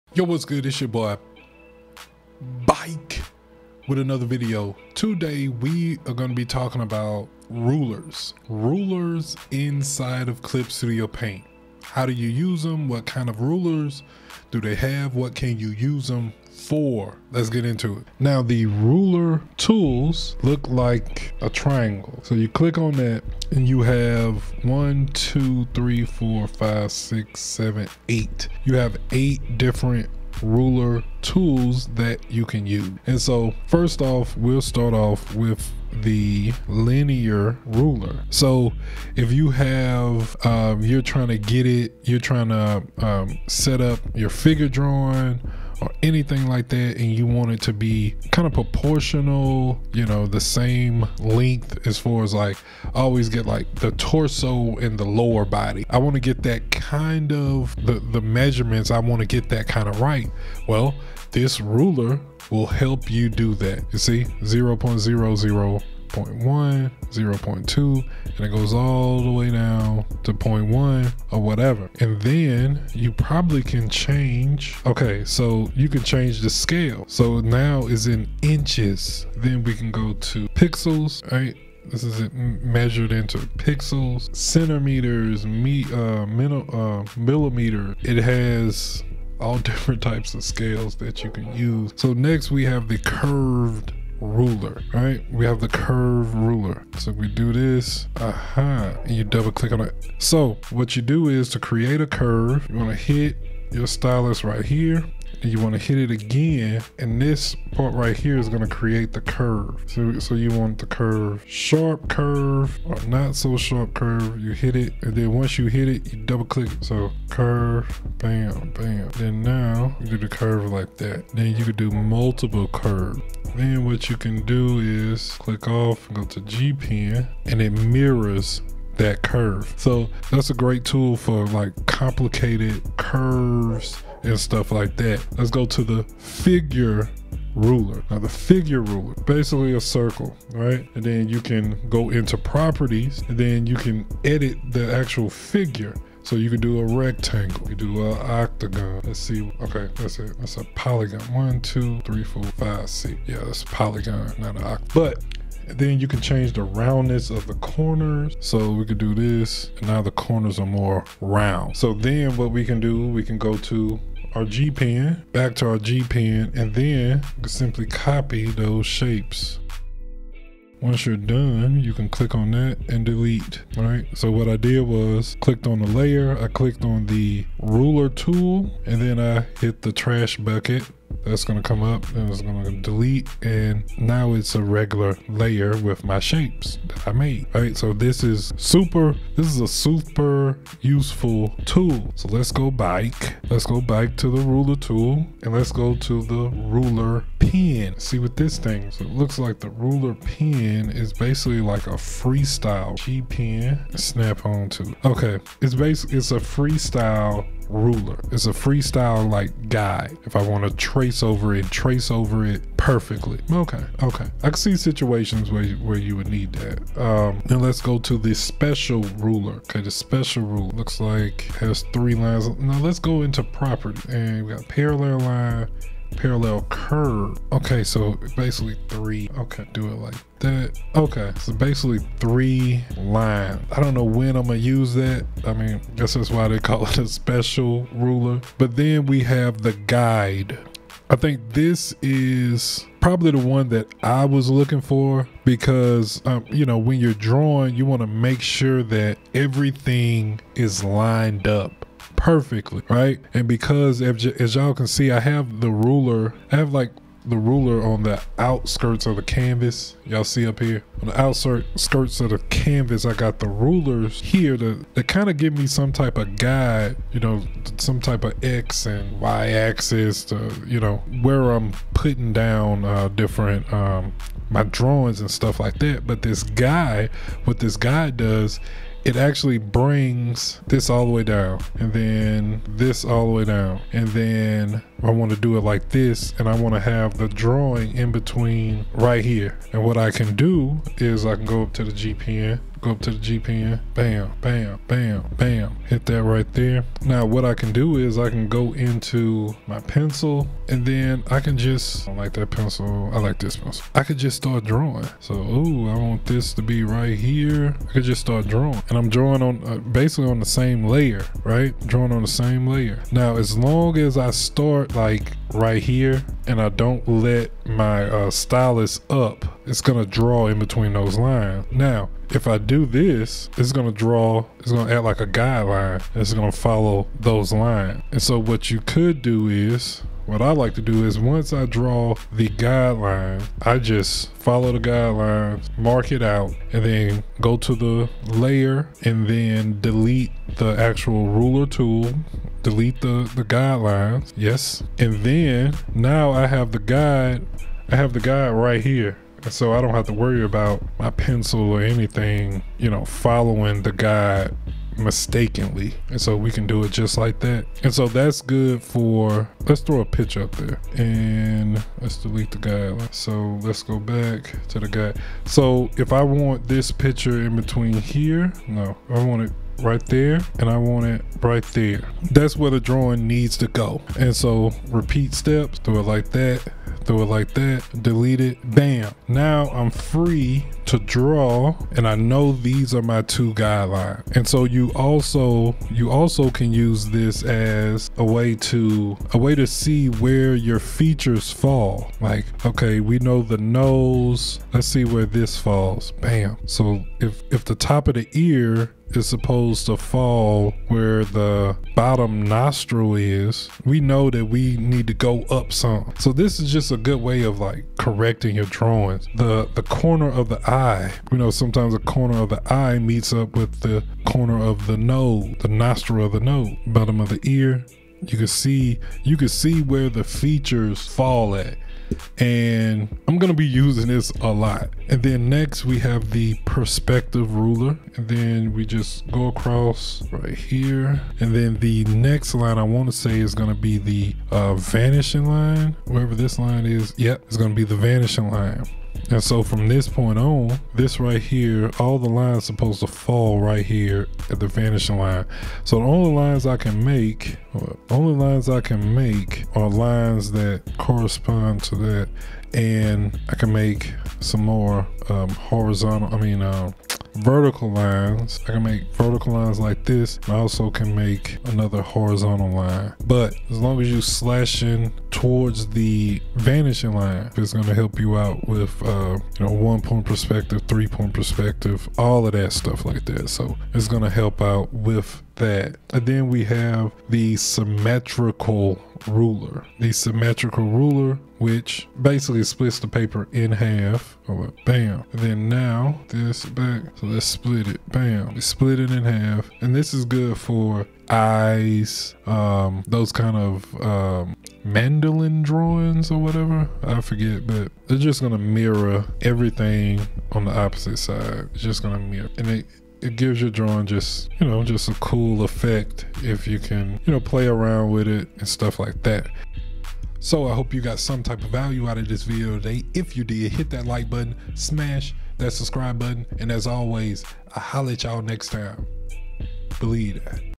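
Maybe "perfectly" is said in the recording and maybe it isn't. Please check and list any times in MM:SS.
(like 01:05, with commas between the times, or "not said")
03:32, 04:12.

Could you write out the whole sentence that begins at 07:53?
So it's gonna help out with that.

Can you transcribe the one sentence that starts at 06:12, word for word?
That's where the drawing needs to go.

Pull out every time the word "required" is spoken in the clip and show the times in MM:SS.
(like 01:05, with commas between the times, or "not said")
not said.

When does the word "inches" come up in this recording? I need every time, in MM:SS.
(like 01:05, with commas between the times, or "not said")
01:18.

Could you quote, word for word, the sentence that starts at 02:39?
And now the corners are more round.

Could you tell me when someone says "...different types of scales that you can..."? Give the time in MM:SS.
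01:29.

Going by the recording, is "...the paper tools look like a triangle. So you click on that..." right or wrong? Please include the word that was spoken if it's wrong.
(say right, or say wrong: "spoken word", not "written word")
wrong: "ruler", not "paper".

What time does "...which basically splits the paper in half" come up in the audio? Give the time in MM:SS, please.
08:01.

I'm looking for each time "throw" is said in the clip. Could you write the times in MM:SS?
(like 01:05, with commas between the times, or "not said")
05:59.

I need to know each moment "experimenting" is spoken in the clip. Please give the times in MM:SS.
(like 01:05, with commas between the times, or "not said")
not said.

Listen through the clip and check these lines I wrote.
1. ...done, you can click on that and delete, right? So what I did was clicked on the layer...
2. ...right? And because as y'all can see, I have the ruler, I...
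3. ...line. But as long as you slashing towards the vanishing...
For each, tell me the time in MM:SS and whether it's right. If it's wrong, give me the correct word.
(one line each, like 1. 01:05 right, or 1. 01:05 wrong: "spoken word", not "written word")
1. 02:51 right
2. 04:12 right
3. 07:42 right.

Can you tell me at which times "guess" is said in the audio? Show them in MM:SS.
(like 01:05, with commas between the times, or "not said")
03:55.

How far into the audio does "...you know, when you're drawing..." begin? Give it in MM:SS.
04:06.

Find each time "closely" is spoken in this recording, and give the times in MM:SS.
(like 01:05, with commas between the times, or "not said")
not said.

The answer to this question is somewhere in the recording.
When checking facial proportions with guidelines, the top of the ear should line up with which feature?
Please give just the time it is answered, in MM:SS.
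06:41.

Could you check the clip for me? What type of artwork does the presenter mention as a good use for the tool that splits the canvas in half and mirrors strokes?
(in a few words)
Mandala drawings.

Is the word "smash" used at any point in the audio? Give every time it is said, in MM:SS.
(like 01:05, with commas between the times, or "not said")
08:34.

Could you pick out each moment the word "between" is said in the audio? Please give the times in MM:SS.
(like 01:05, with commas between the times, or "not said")
04:48, 05:20, 06:07.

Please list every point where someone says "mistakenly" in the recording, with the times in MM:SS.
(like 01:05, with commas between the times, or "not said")
05:54.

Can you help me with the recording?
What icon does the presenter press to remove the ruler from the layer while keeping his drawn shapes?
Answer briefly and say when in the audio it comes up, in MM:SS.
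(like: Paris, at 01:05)
Trash bucket, at 02:59.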